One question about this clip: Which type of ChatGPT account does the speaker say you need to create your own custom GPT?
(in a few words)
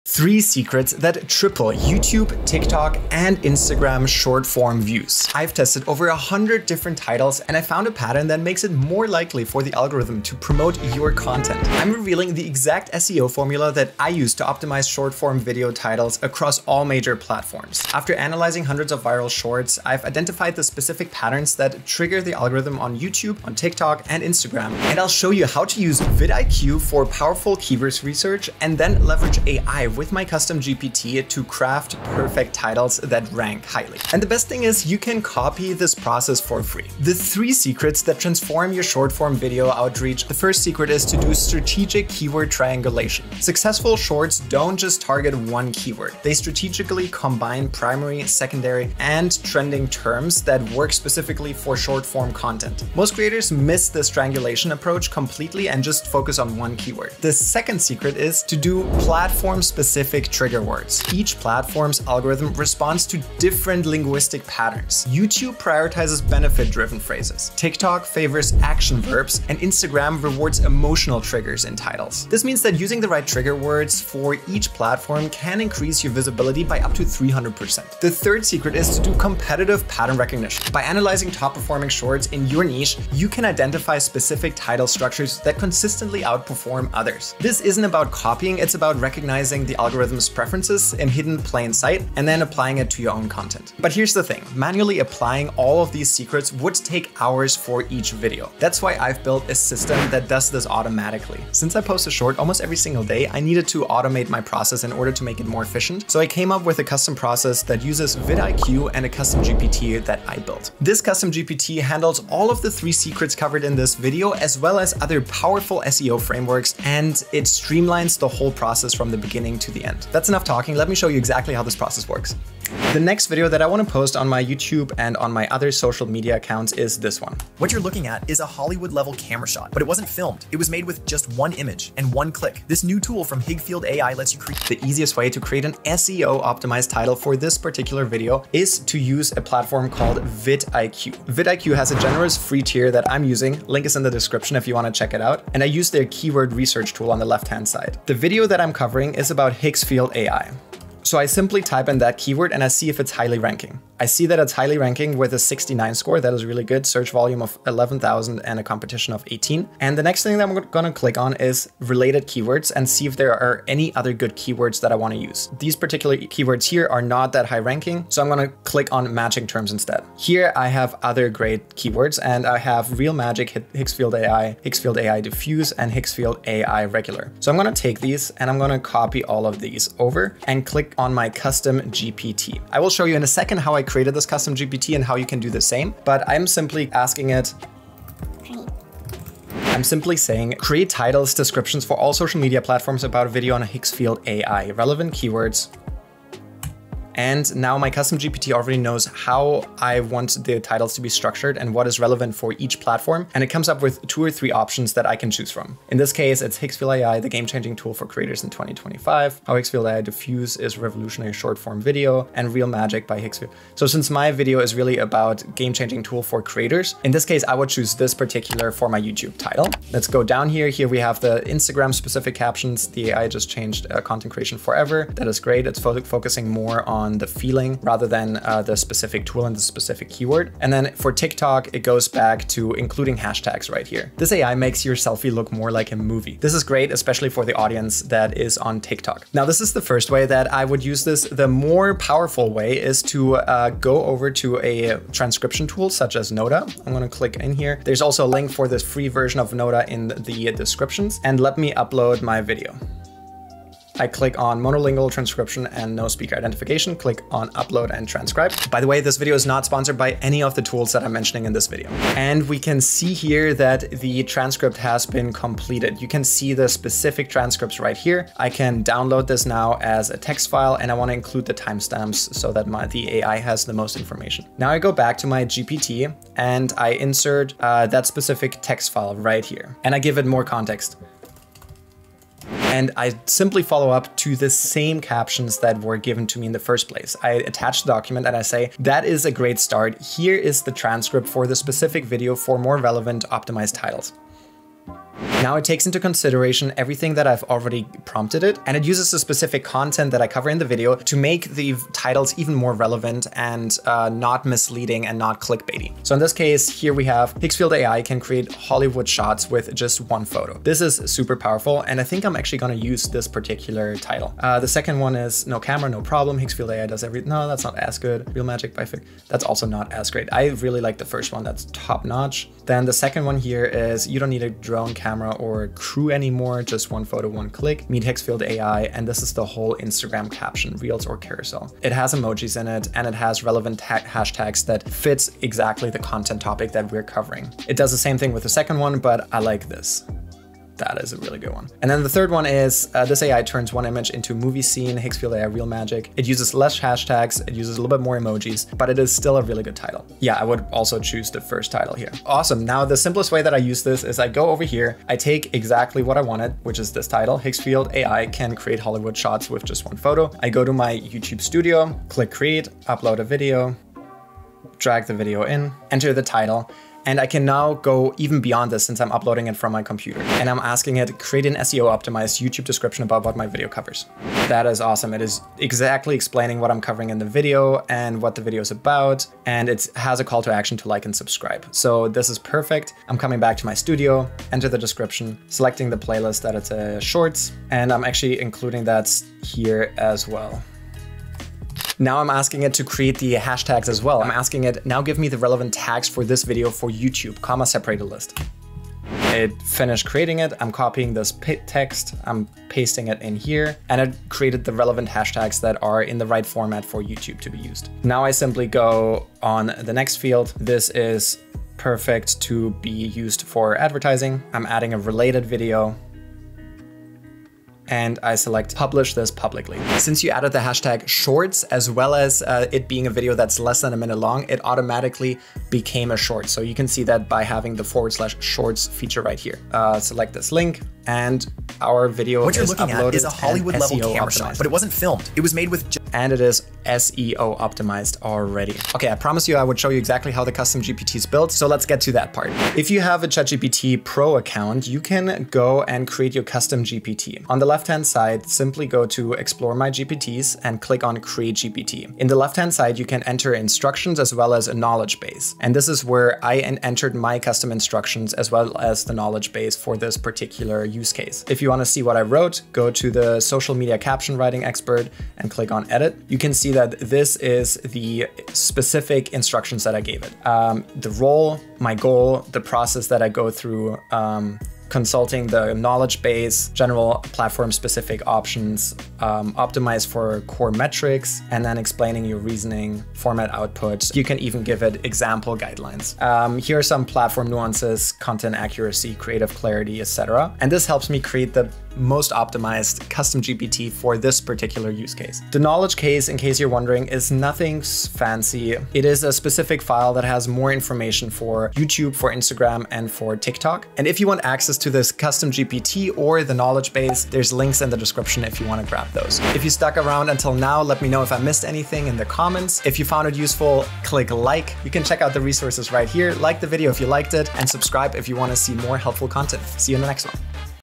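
ChatGPT Pro.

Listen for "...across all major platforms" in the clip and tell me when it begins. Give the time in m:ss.
0:16.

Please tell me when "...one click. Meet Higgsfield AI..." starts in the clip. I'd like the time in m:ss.
5:27.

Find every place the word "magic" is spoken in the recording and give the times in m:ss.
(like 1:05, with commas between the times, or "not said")
2:53, 3:32, 5:18, 5:45.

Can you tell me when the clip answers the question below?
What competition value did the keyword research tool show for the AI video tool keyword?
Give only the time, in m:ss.
2:39.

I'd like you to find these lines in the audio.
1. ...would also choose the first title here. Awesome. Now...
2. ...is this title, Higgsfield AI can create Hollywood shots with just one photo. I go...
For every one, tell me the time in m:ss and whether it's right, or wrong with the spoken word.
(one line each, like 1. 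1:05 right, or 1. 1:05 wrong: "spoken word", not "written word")
1. 5:50 right
2. 5:56 right.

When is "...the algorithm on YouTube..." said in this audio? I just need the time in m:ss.
0:22.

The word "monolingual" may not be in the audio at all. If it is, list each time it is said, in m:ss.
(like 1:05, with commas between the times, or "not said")
4:14.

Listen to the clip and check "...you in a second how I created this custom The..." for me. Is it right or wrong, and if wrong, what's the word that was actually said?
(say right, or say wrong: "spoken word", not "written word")
wrong: "GPT", not "The".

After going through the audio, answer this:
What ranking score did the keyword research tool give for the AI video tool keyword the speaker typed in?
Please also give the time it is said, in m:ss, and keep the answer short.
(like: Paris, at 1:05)
69, at 2:35.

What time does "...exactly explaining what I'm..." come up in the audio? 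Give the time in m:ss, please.
6:15.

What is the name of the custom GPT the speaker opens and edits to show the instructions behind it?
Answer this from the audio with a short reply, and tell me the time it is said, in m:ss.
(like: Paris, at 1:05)
social media caption writing expert, at 7:43.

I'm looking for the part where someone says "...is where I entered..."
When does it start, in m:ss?
7:35.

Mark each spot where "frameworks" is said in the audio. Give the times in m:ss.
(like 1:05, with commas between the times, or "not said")
1:56.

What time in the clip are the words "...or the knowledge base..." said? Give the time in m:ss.
8:26.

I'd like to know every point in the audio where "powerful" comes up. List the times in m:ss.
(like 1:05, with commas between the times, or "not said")
0:27, 1:55, 4:01, 5:11.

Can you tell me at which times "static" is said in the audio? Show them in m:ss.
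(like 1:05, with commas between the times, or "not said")
not said.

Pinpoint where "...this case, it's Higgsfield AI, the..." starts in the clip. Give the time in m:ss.
3:25.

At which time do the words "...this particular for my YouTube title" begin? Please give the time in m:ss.
3:37.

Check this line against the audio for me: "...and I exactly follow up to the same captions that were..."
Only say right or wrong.
wrong.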